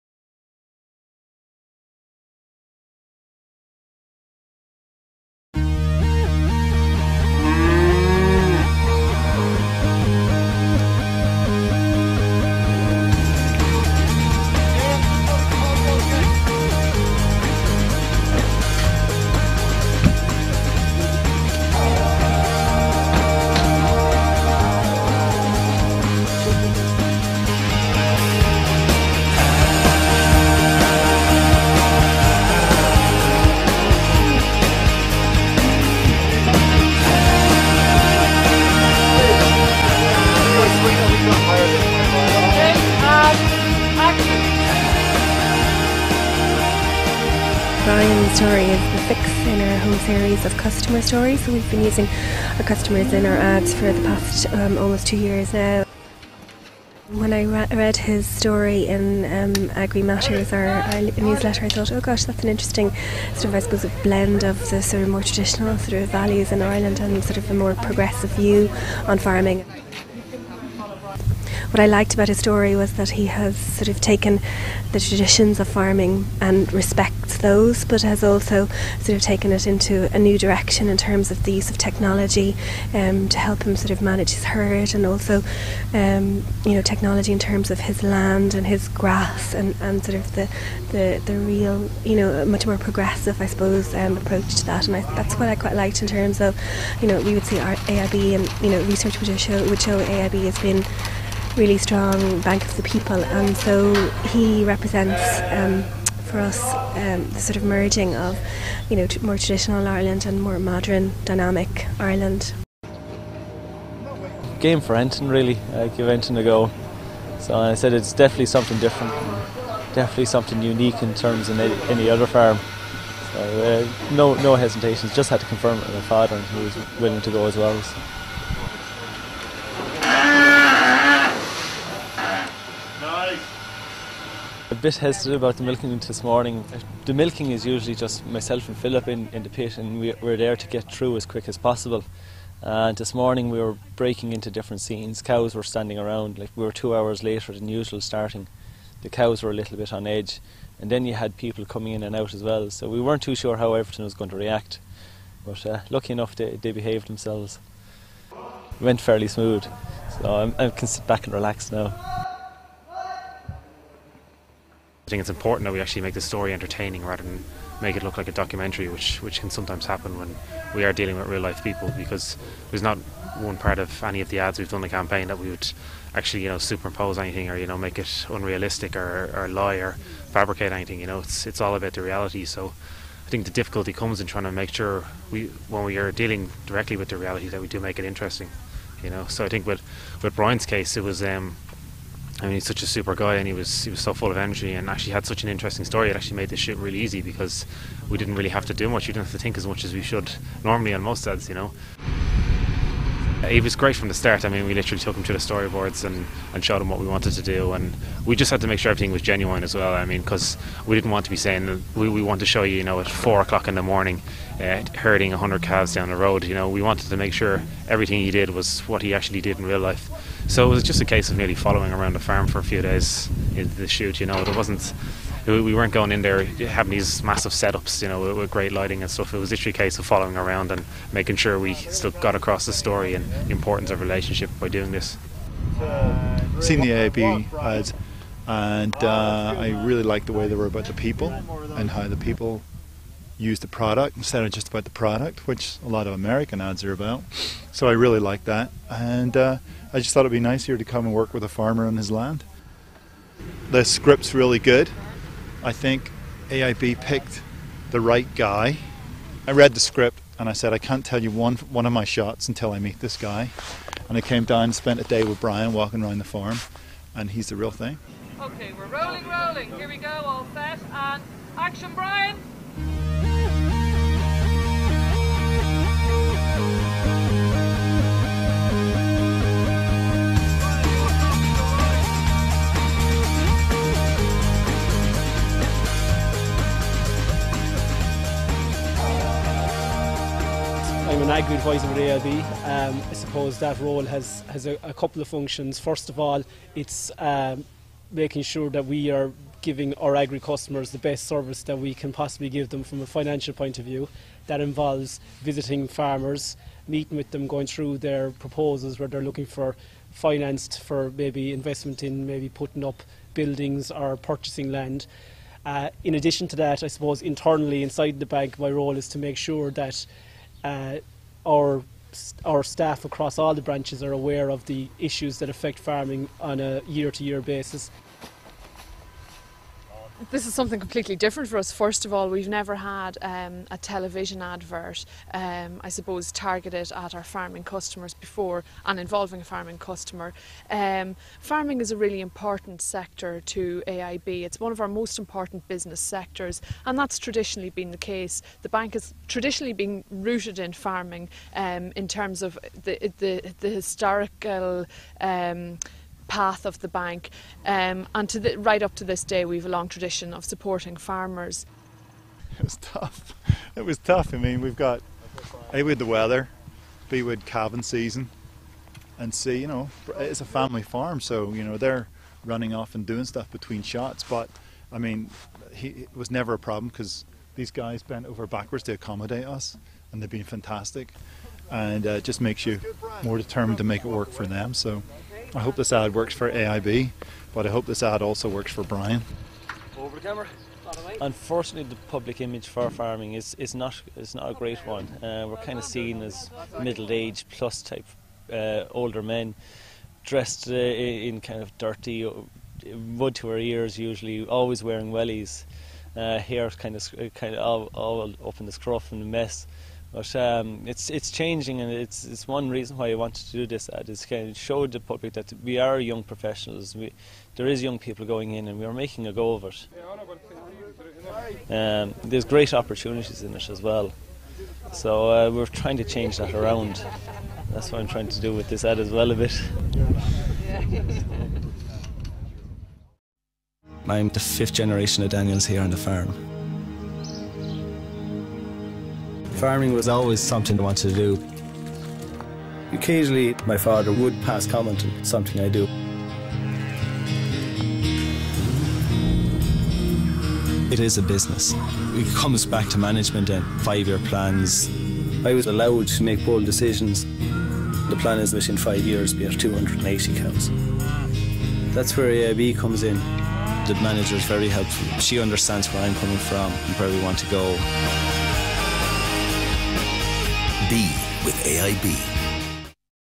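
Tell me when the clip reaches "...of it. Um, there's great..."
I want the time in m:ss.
6:59.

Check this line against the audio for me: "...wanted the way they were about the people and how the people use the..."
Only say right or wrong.
wrong.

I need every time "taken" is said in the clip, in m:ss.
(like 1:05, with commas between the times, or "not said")
1:14, 1:19.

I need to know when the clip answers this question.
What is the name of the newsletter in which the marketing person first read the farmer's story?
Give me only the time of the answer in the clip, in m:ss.
0:59.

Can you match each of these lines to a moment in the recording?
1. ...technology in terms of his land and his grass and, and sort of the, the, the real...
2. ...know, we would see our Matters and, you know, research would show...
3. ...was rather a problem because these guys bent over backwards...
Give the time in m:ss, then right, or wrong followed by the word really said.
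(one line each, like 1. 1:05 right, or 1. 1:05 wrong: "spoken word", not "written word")
1. 1:26 right
2. 1:37 wrong: "AIB", not "Matters"
3. 6:16 wrong: "never", not "rather".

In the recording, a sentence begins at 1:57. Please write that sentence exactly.
So I said it's definitely something different, definitely something unique in terms of any other farm.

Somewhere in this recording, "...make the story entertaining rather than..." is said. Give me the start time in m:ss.
2:46.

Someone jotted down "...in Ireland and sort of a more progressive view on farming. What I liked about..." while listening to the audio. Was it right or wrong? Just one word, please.
right.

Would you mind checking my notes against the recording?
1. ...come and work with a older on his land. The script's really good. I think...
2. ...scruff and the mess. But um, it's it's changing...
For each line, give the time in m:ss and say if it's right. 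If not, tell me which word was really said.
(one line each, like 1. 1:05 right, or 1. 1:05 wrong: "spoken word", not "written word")
1. 4:10 wrong: "farmer", not "older"
2. 6:48 right.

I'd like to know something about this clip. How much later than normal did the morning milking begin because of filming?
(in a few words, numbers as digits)
2 hours.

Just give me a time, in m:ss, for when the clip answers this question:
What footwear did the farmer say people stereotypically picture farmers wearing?
6:45.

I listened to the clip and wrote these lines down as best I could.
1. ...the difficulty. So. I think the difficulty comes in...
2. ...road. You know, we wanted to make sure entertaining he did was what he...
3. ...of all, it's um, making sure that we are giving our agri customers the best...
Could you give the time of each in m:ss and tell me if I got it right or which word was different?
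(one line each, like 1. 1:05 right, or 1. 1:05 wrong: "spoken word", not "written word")
1. 3:01 wrong: "reality", not "difficulty"
2. 3:36 wrong: "everything", not "entertaining"
3. 4:56 right.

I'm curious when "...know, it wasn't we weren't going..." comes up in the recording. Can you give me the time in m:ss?
3:44.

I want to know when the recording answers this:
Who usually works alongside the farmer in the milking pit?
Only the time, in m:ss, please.
2:18.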